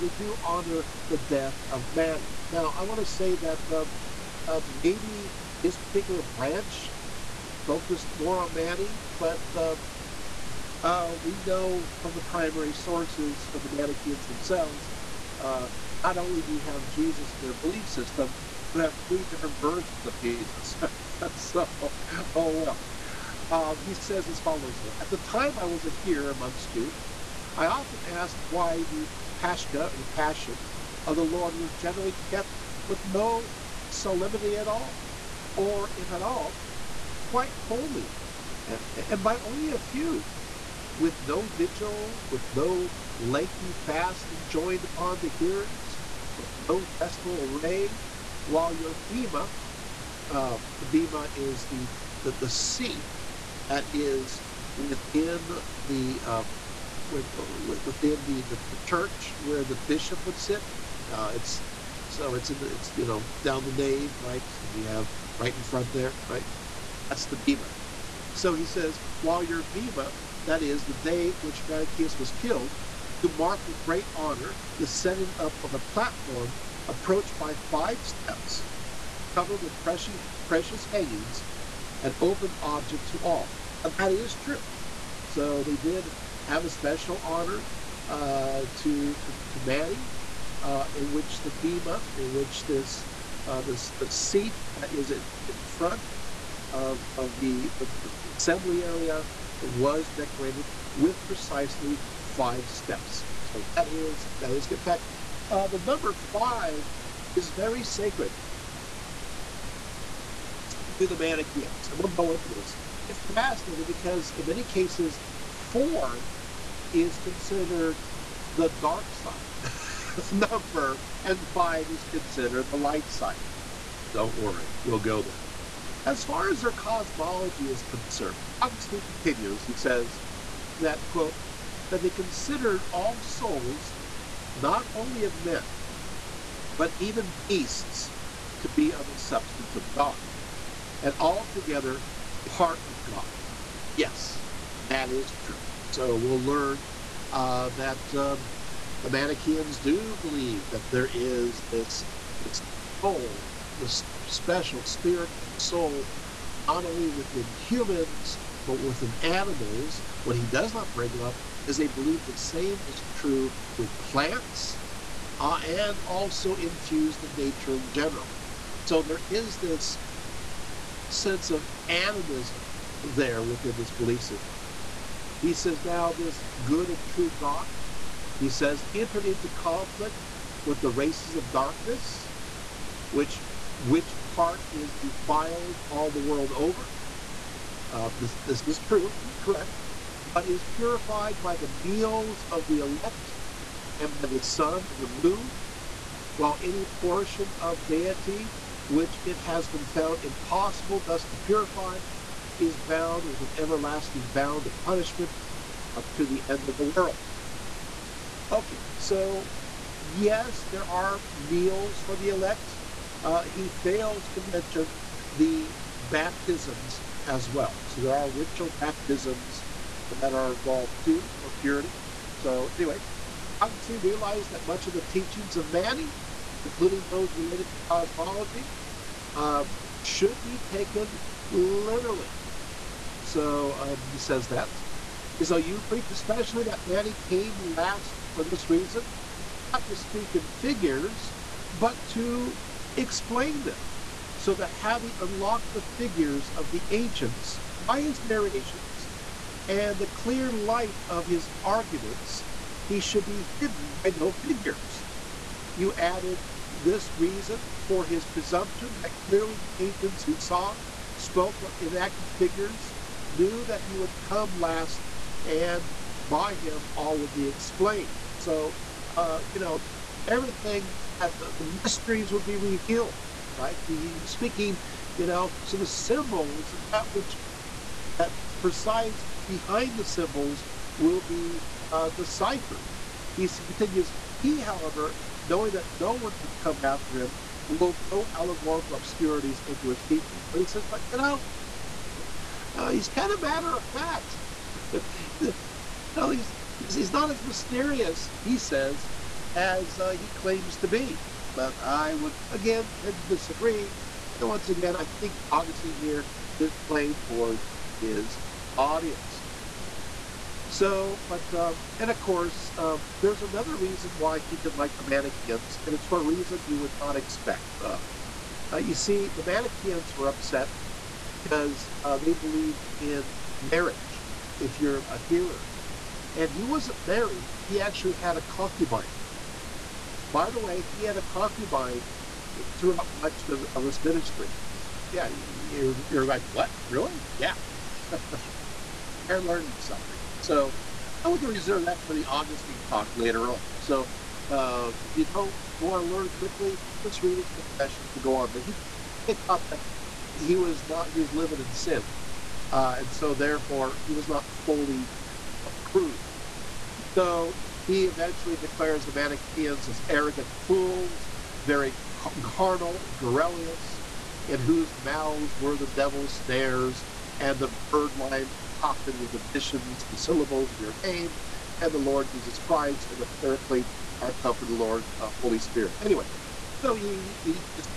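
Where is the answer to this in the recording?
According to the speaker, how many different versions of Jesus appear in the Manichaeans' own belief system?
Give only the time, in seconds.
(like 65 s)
19 s.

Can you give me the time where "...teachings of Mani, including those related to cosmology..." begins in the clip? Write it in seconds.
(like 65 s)
225 s.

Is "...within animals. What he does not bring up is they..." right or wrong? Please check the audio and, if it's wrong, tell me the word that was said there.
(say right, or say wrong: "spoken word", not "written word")
right.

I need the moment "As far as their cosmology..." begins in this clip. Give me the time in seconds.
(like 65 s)
126 s.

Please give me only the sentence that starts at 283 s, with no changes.
he continues, he, however, knowing that no one would come after him, will no allegorical obscurities into his teaching.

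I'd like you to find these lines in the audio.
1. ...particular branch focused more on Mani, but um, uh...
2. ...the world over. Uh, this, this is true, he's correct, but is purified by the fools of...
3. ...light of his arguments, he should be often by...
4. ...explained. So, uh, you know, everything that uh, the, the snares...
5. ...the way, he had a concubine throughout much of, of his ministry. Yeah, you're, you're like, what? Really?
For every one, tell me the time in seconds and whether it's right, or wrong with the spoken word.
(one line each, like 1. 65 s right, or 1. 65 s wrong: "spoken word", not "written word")
1. 5 s right
2. 186 s wrong: "meals", not "fools"
3. 250 s wrong: "hidden", not "often"
4. 267 s wrong: "mysteries", not "snares"
5. 330 s right.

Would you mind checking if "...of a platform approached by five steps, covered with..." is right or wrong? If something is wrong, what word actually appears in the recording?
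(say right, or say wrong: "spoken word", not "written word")
right.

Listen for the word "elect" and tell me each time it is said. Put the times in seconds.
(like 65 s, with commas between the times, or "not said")
192 s, 212 s.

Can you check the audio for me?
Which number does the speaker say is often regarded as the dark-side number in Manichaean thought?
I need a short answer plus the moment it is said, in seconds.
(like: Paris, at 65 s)
4, at 115 s.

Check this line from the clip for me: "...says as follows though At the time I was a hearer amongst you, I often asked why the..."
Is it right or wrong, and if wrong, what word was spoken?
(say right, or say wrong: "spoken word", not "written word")
right.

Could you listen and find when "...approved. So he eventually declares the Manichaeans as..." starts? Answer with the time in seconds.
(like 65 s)
355 s.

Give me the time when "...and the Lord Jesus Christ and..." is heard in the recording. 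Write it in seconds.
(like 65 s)
371 s.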